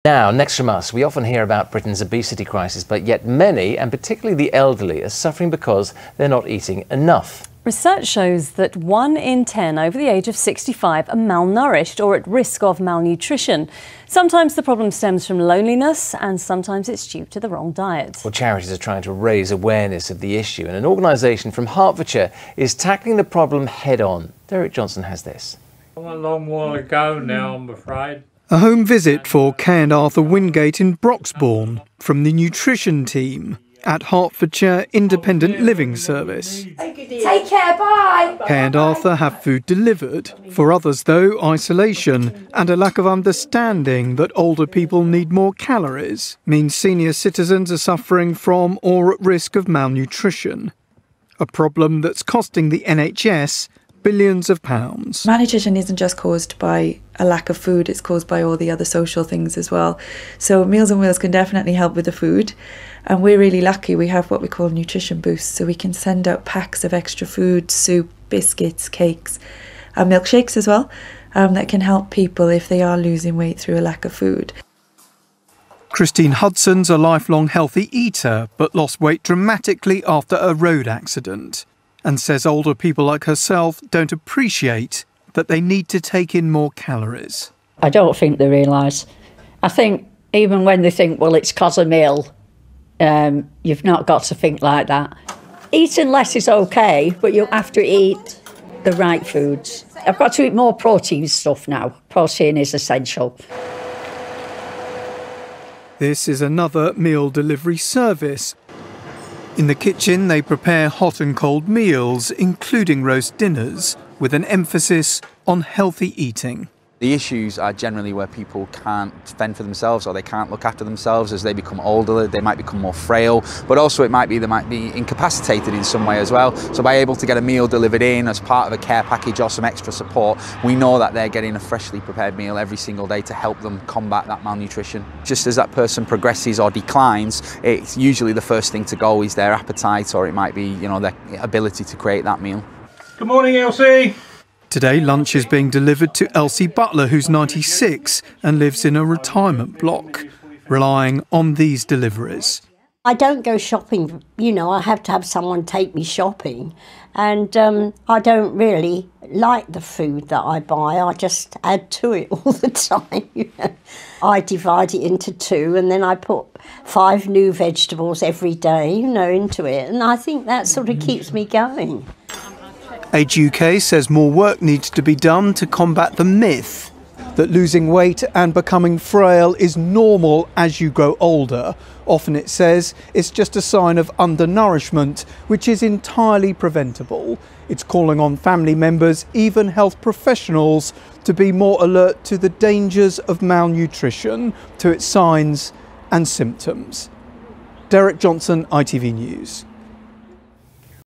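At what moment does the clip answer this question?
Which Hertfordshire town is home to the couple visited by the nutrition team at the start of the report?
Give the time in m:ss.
0:30.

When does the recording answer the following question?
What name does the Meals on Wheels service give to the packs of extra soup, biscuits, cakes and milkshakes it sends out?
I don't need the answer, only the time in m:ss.
1:04.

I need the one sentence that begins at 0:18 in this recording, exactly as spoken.
Well, charities are trying to raise awareness of the issue, and an organisation from Hertfordshire is tackling the problem head on.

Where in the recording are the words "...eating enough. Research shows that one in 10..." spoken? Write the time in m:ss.
0:06.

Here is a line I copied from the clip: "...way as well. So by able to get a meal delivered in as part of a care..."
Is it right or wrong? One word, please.
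right.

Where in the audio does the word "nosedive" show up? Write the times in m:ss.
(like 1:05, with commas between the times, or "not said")
not said.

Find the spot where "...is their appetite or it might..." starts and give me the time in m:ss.
2:19.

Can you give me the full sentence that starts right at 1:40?
I've got to eat more protein stuff now.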